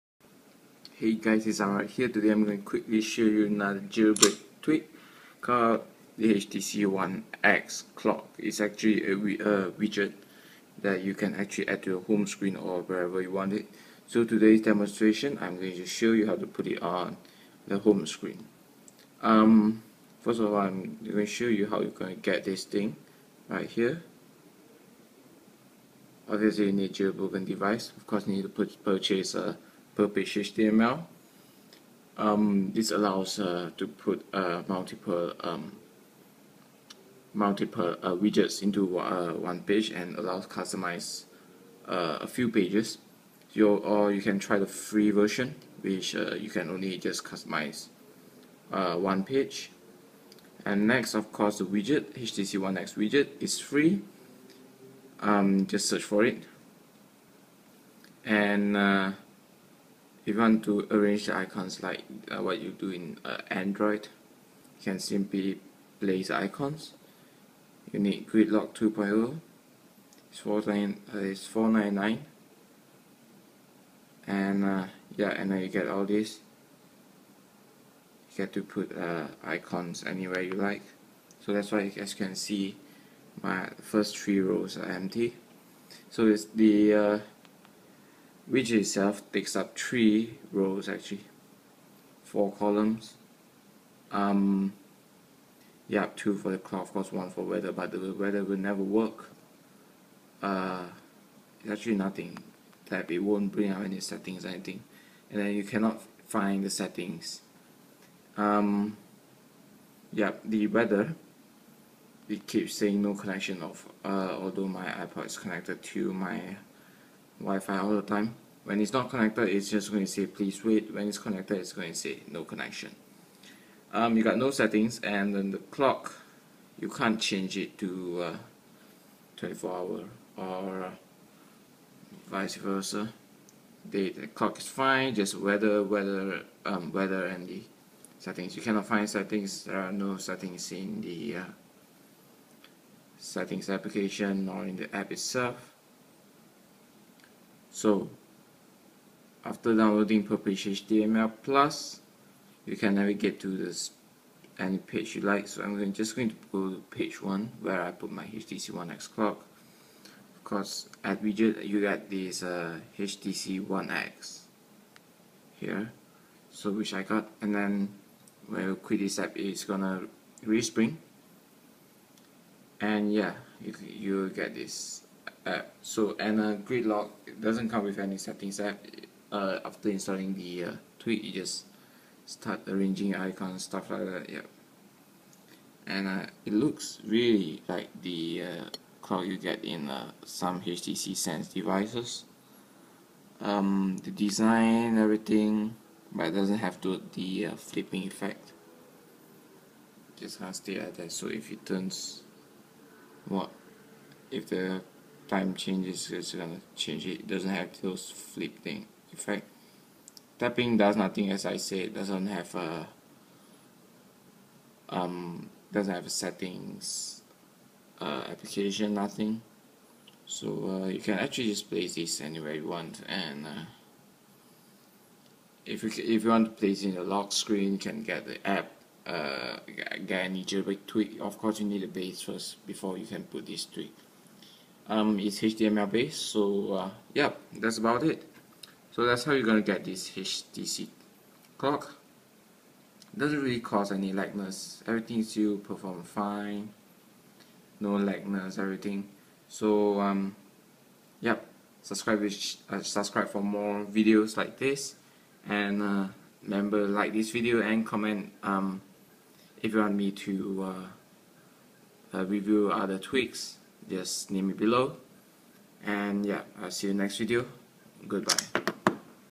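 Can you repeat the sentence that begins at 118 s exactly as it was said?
When it's not connected, it's just going to say please wait.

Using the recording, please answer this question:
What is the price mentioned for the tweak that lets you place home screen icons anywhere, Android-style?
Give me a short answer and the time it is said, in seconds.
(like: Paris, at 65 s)
4.99, at 70 s.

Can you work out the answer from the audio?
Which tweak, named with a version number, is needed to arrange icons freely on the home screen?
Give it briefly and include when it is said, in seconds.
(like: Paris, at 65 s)
Gridlock 2.0, at 68 s.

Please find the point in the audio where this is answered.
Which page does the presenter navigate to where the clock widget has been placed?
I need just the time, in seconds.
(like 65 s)
156 s.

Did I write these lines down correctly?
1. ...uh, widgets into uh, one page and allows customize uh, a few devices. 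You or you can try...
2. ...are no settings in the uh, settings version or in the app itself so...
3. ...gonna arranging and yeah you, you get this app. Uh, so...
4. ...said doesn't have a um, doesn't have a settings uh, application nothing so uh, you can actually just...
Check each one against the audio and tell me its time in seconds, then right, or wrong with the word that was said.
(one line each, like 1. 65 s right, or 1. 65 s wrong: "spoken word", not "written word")
1. 38 s wrong: "pages", not "devices"
2. 139 s wrong: "application", not "version"
3. 169 s wrong: "respring", not "arranging"
4. 211 s right.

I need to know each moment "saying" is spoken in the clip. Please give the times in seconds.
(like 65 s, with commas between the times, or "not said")
112 s.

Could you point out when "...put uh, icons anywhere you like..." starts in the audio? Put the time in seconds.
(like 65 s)
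78 s.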